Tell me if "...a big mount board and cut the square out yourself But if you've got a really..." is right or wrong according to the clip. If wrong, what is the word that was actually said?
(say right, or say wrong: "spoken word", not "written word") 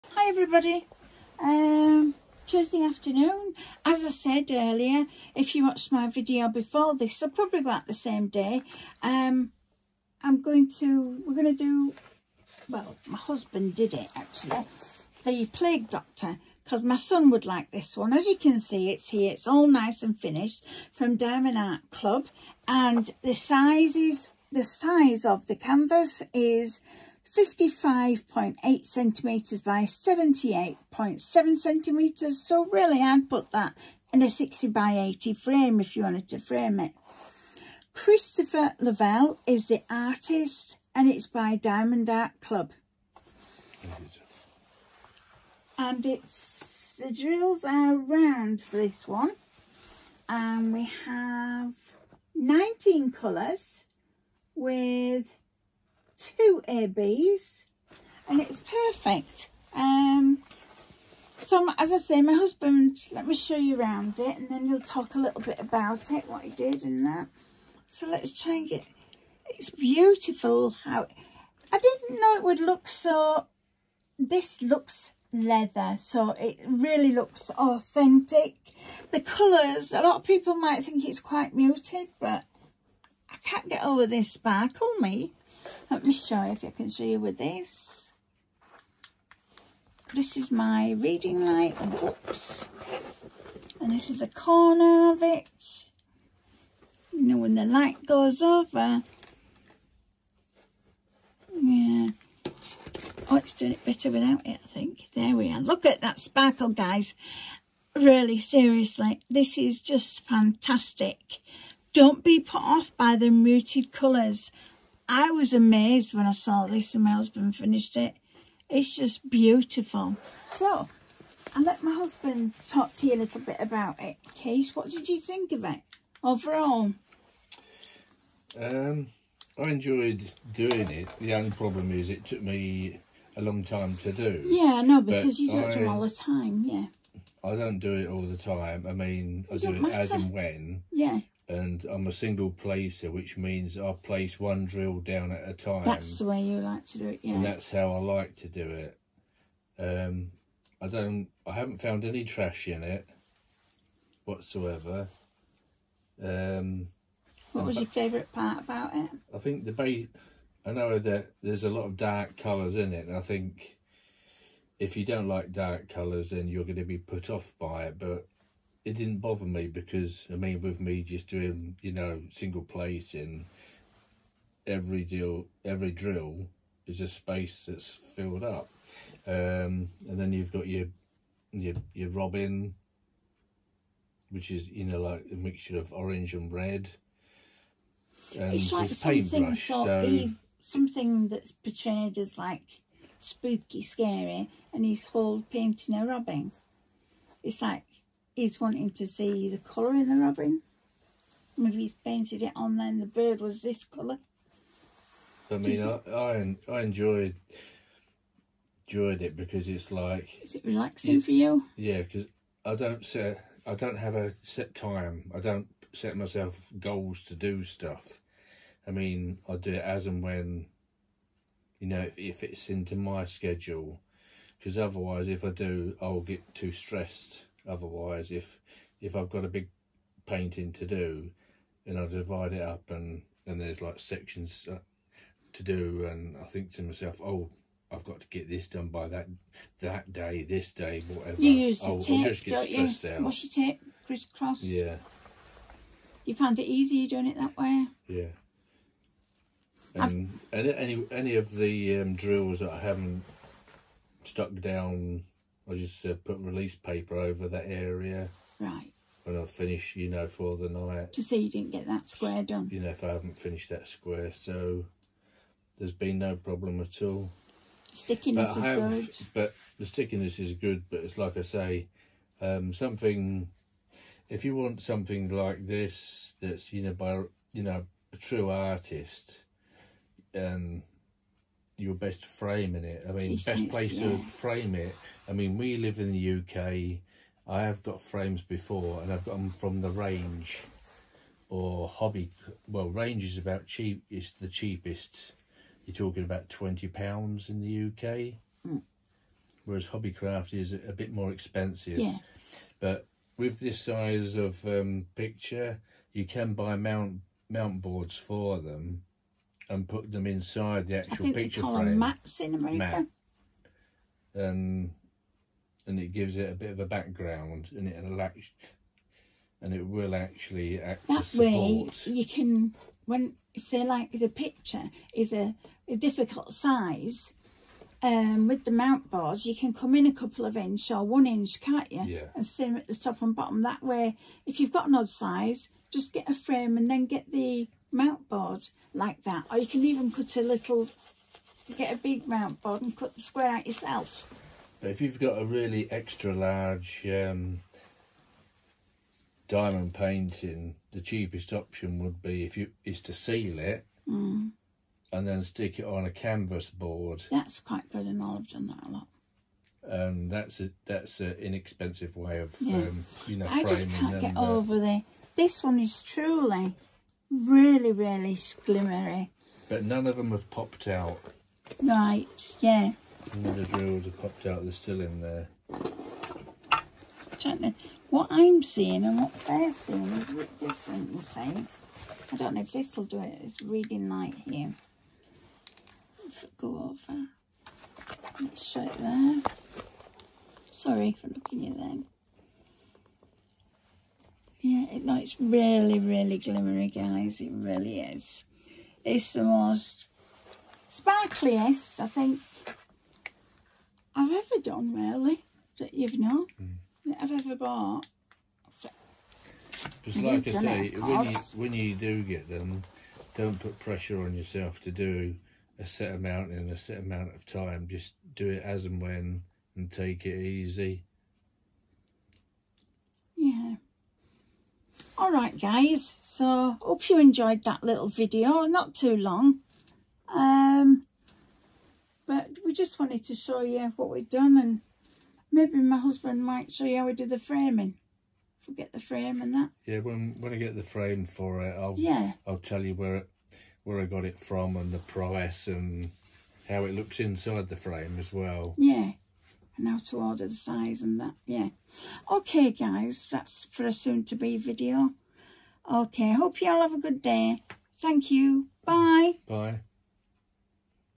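right.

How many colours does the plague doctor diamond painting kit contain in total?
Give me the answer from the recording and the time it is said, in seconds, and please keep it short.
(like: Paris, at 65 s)
19, at 52 s.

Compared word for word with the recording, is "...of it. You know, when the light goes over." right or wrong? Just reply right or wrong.
right.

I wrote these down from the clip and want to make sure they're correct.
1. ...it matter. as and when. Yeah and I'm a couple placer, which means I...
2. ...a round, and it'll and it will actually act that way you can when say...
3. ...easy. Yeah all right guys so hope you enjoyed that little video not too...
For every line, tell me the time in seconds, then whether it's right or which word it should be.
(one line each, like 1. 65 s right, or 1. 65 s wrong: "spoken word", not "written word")
1. 139 s wrong: "single", not "couple"
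2. 316 s wrong: "background", not "round"
3. 420 s right.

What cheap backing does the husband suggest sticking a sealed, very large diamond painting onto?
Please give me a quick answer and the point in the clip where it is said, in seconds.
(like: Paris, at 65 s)
Canvas board, at 356 s.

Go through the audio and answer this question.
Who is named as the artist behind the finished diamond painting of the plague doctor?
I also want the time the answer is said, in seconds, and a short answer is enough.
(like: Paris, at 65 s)
Christopher Lovell, at 37 s.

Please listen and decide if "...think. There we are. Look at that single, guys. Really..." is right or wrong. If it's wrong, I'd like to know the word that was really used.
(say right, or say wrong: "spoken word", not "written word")
wrong: "sparkle", not "single".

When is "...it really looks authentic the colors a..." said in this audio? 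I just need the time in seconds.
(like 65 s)
76 s.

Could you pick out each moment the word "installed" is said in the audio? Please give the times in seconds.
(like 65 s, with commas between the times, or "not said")
not said.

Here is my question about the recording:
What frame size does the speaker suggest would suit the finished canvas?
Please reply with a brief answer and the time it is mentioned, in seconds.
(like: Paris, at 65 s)
60 by 80, at 34 s.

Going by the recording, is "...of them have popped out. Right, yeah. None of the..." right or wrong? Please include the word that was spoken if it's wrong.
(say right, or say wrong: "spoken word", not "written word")
right.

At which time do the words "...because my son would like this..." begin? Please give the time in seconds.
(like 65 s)
16 s.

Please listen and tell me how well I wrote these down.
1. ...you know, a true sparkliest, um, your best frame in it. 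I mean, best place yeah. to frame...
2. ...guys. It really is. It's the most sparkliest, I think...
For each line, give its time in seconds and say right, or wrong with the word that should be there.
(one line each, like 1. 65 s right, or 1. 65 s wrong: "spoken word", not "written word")
1. 277 s wrong: "artist", not "sparkliest"
2. 396 s right.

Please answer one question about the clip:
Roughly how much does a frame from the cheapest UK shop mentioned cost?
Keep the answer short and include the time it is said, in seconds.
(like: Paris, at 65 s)
20 pounds, at 296 s.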